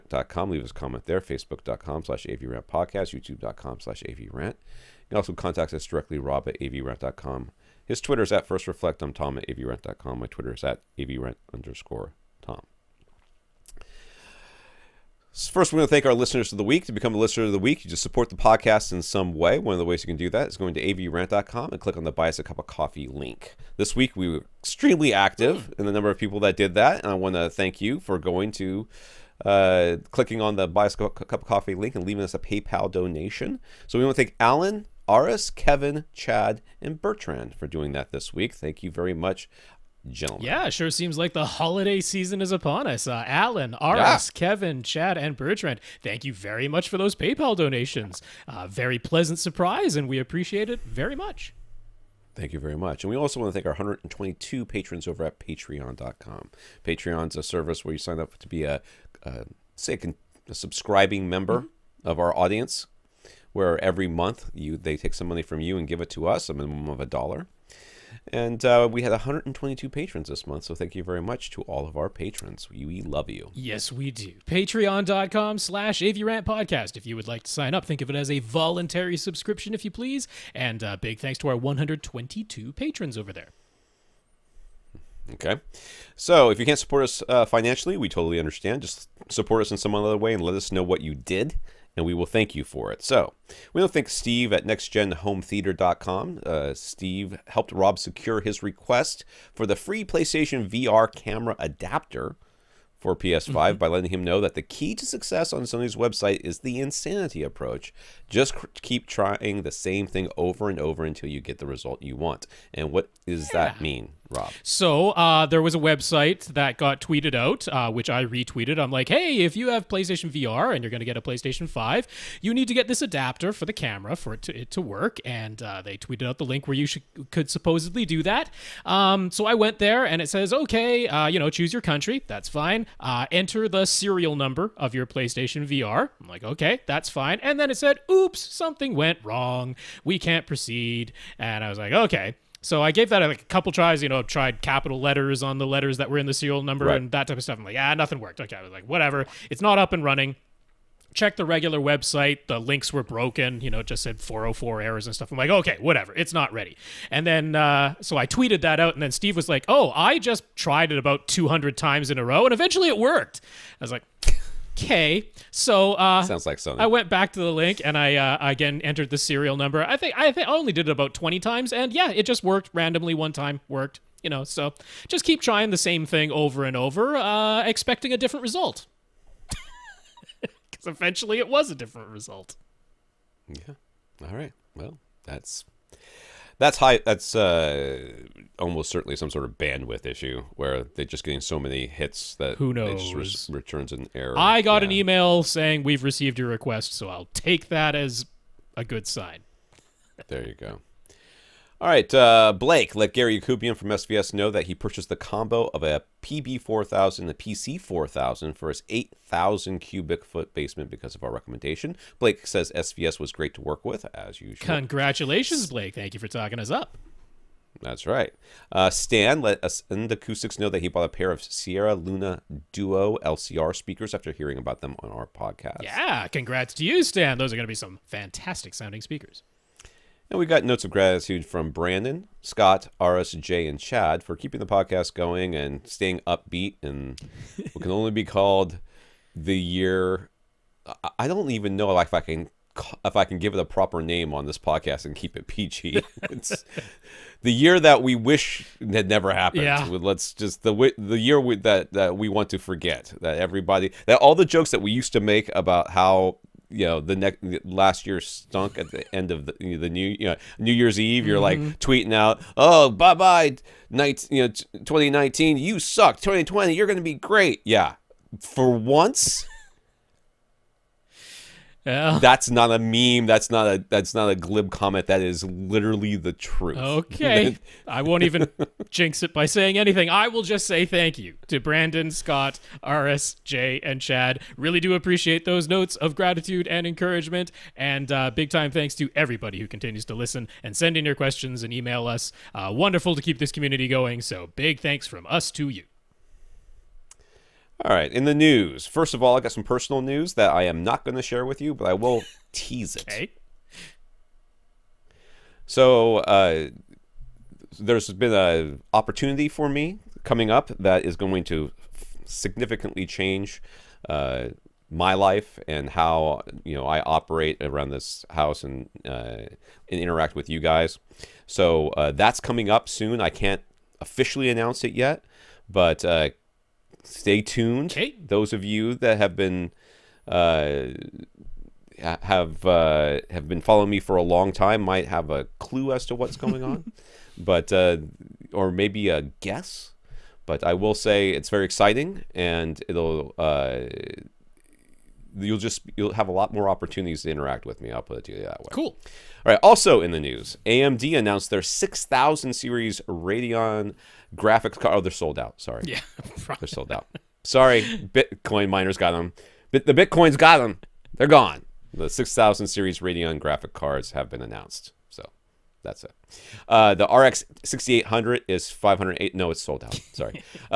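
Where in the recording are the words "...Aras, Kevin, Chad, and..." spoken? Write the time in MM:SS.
00:35.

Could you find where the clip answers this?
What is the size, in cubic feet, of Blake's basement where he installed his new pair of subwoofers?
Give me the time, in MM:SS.
03:28.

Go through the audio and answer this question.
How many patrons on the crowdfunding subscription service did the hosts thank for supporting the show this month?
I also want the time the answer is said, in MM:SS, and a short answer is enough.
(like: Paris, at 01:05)
122, at 01:09.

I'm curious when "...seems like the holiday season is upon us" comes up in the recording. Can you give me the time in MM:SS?
00:40.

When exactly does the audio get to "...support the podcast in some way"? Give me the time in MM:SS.
00:18.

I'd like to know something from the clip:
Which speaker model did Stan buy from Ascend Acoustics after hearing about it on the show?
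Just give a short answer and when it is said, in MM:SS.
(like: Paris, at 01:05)
Sierra Luna Duo LCR, at 03:41.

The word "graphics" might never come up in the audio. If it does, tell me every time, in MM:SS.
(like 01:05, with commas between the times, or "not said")
05:54, 06:03.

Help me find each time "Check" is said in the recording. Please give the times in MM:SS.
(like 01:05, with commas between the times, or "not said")
02:31.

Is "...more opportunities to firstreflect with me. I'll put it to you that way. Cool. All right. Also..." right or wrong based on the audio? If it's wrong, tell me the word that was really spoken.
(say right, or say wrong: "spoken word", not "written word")
wrong: "interact", not "firstreflect".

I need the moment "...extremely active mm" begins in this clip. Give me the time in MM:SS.
00:24.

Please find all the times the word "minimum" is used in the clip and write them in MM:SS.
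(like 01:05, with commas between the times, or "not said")
01:06.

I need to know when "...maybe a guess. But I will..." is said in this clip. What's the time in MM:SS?
05:38.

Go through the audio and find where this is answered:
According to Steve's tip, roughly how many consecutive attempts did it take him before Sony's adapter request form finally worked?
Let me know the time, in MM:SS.
02:41.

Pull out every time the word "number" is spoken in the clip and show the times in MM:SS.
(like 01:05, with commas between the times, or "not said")
00:25, 02:14, 02:26, 02:49.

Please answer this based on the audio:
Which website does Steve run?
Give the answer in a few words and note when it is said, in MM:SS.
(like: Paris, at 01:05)
nextgenhometheater.com, at 01:34.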